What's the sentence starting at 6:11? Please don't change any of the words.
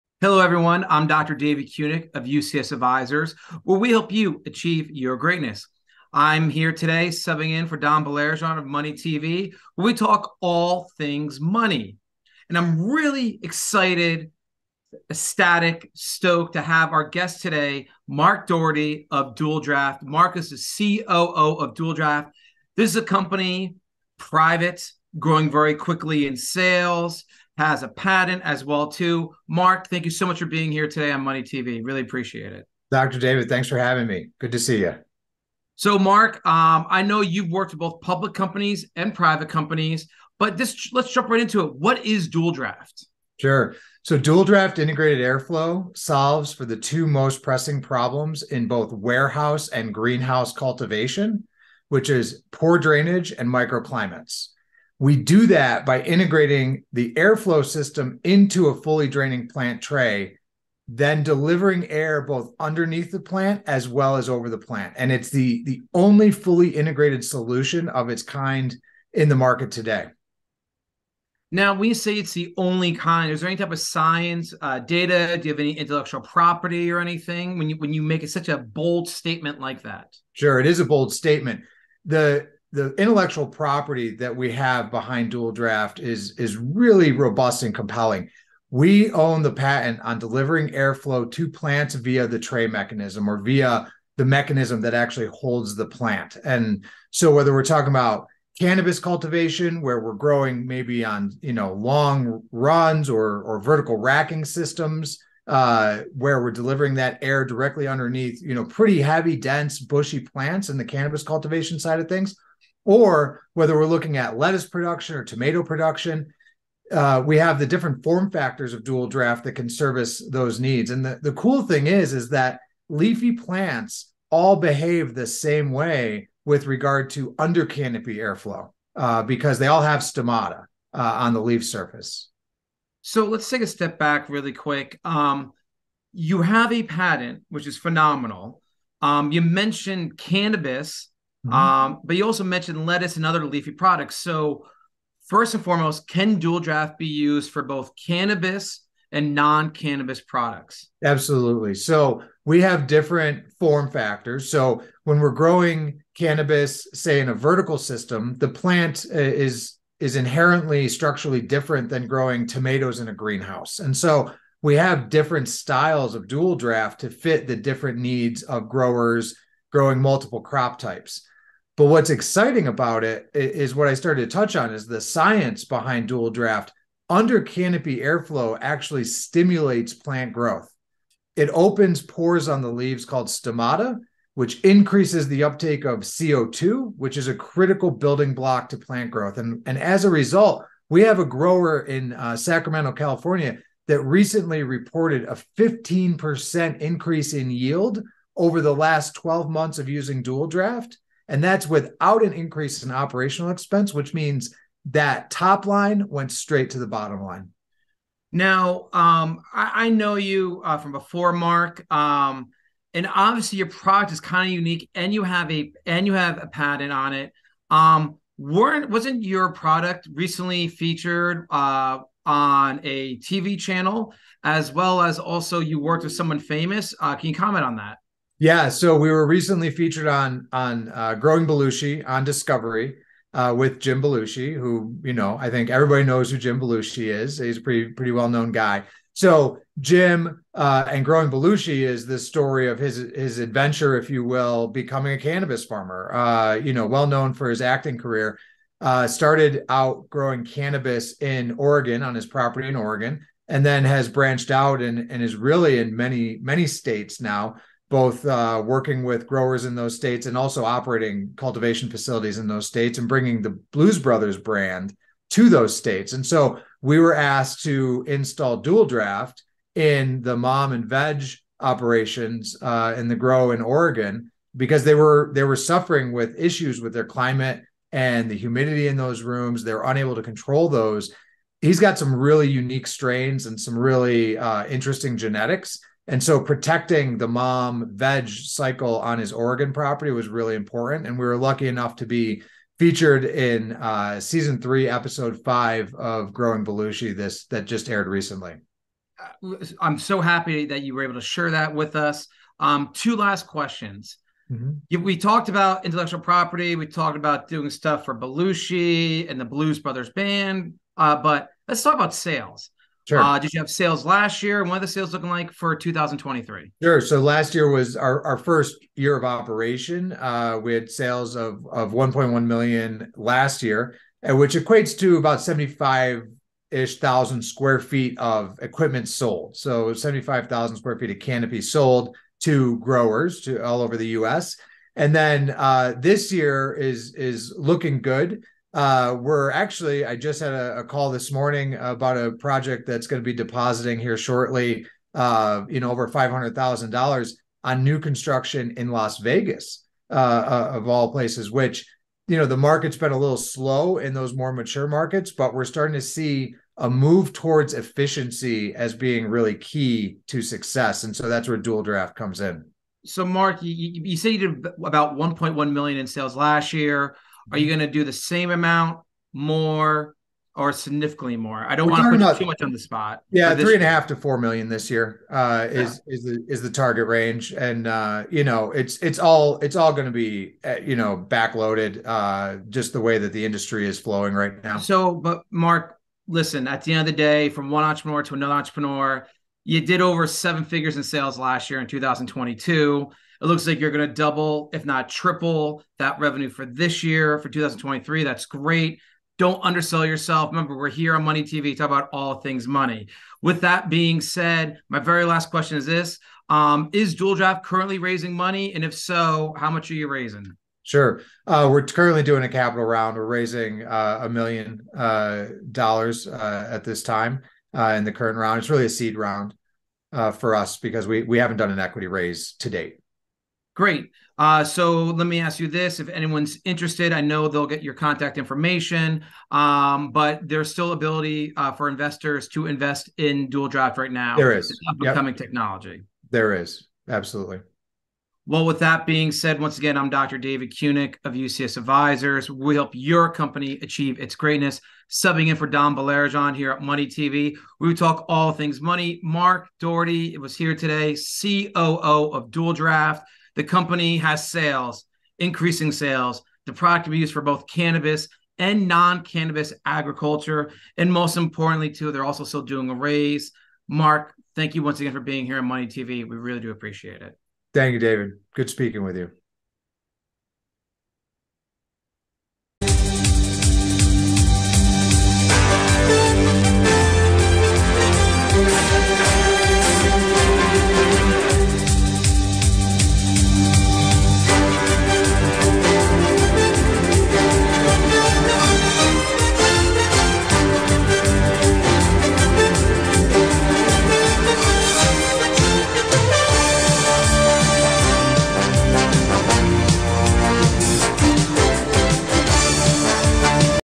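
I don't want to put about, too much on the spot.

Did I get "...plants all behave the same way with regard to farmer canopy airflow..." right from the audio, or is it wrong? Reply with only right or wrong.
wrong.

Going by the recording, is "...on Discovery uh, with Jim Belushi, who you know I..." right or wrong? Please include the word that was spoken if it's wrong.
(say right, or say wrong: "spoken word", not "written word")
right.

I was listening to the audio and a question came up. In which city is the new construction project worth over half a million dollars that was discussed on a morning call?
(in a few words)
Las Vegas.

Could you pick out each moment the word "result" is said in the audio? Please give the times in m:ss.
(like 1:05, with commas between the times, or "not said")
3:10.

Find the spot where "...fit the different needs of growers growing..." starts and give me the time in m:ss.
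2:47.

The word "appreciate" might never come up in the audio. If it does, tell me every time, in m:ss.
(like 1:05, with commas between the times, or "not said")
0:32, 7:46.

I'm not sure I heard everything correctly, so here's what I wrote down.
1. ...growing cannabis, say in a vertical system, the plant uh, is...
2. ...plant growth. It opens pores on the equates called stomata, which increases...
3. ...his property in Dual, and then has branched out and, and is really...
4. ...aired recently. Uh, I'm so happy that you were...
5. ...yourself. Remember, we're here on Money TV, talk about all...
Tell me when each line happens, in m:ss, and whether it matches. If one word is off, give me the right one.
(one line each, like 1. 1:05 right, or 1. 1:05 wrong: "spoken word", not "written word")
1. 2:35 right
2. 2:59 wrong: "leaves", not "equates"
3. 4:12 wrong: "Oregon", not "Dual"
4. 4:57 right
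5. 6:40 right.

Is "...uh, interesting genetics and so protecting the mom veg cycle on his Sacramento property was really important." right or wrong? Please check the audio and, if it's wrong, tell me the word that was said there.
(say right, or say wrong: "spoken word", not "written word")
wrong: "Oregon", not "Sacramento".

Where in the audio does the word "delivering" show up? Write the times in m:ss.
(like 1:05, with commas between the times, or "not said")
1:01, 1:30, 1:46.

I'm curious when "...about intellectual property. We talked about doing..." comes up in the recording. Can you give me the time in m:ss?
5:05.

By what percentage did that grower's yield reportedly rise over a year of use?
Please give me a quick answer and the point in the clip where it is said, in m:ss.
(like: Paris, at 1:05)
15%, at 3:15.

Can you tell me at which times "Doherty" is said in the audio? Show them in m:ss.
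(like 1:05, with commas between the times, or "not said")
0:18, 7:29.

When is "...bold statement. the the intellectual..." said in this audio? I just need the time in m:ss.
1:20.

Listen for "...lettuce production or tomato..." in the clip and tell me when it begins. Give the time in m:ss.
1:54.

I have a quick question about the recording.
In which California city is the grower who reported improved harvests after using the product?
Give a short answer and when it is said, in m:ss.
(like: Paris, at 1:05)
Sacramento, at 3:12.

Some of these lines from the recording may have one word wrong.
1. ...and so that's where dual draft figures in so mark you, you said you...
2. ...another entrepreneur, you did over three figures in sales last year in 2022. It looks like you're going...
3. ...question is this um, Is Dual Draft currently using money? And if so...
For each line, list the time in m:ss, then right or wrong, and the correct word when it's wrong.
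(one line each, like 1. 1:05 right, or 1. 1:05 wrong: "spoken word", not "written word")
1. 6:01 wrong: "comes", not "figures"
2. 6:28 wrong: "seven", not "three"
3. 6:45 wrong: "raising", not "using".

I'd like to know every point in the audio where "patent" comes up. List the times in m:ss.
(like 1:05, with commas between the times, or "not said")
0:27, 1:29, 2:16, 3:36.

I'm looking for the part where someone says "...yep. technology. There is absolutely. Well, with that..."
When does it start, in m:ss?
7:15.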